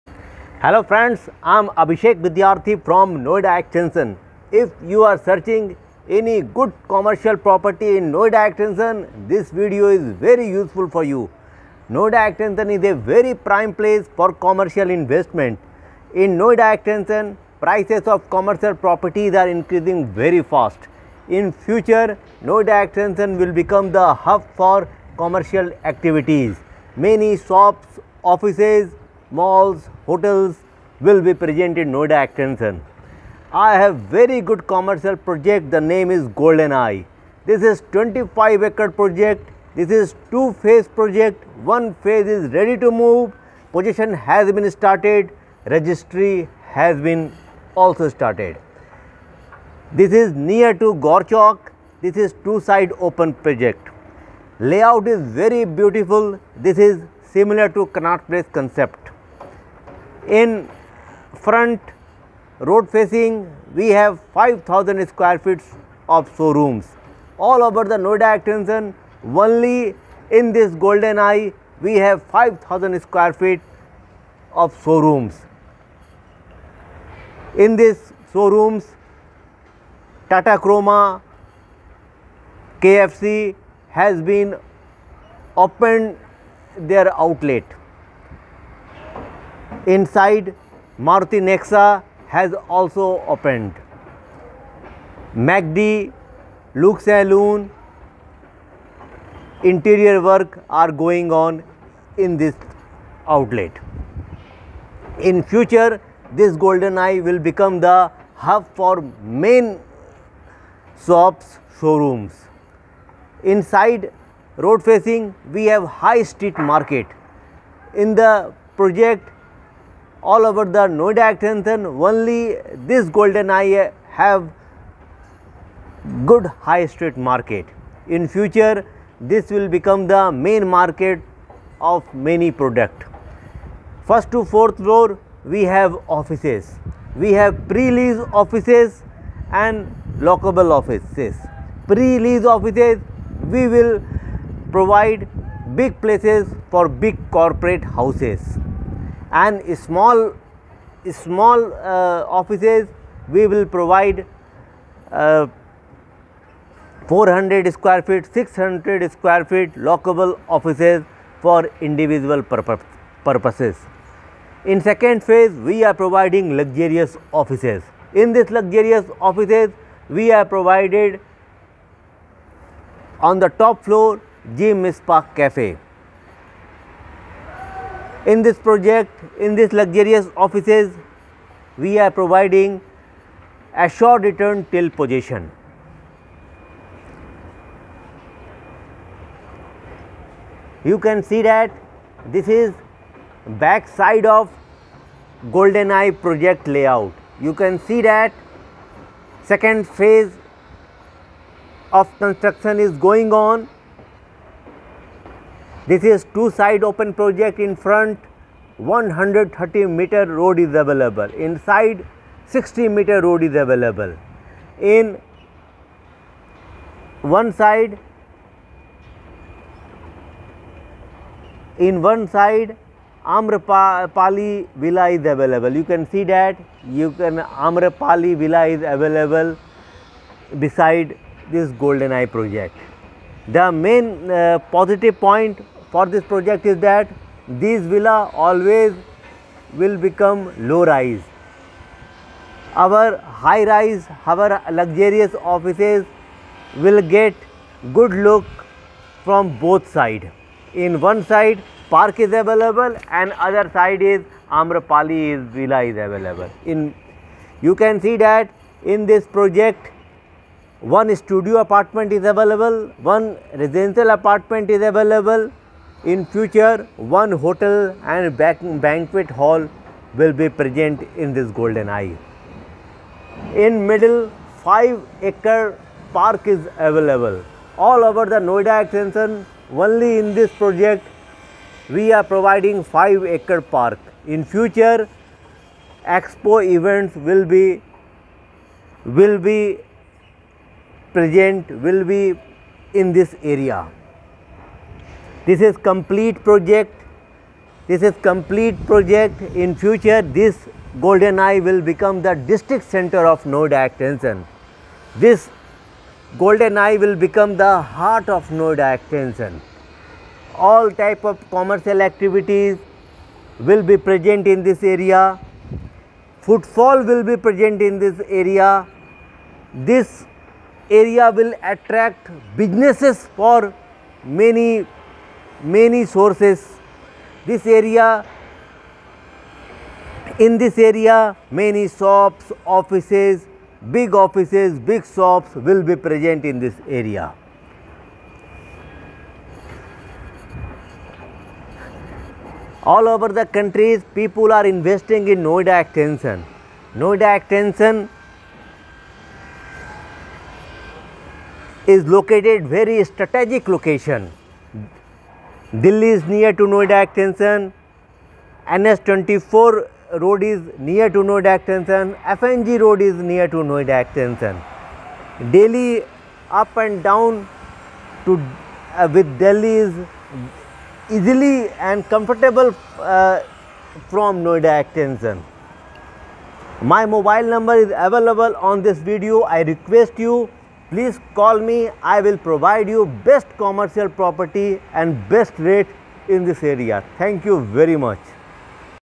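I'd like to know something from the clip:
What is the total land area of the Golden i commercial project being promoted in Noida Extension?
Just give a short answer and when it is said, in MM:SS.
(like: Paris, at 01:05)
25 acre, at 00:37.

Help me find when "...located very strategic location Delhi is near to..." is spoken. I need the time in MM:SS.
05:52.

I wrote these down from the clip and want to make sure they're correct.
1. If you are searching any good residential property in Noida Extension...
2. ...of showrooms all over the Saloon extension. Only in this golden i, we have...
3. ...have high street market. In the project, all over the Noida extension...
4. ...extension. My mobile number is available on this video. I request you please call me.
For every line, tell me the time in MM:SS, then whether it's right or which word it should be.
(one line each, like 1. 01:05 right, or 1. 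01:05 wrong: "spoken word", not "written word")
1. 00:04 wrong: "commercial", not "residential"
2. 01:06 wrong: "Noida", not "Saloon"
3. 01:55 right
4. 06:14 right.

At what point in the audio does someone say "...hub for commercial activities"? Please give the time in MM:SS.
00:24.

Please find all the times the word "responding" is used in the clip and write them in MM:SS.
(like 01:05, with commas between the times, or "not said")
not said.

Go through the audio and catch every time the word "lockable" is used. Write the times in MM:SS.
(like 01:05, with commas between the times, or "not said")
02:20, 02:39.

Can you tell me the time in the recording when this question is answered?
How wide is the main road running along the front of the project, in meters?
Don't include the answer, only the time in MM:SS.
03:28.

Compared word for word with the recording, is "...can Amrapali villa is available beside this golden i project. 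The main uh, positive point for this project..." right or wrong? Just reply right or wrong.
right.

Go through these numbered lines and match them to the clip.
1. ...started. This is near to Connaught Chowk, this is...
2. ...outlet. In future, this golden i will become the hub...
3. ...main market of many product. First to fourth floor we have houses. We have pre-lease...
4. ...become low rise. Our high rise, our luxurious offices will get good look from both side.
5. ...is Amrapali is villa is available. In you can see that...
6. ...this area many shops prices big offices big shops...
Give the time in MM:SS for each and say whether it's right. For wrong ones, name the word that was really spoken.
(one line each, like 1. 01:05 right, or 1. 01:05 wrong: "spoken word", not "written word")
1. 00:48 wrong: "Gaur", not "Connaught"
2. 01:43 right
3. 02:10 wrong: "offices", not "houses"
4. 03:59 right
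5. 04:14 right
6. 05:30 wrong: "offices", not "prices".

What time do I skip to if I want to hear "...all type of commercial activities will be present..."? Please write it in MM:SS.
05:10.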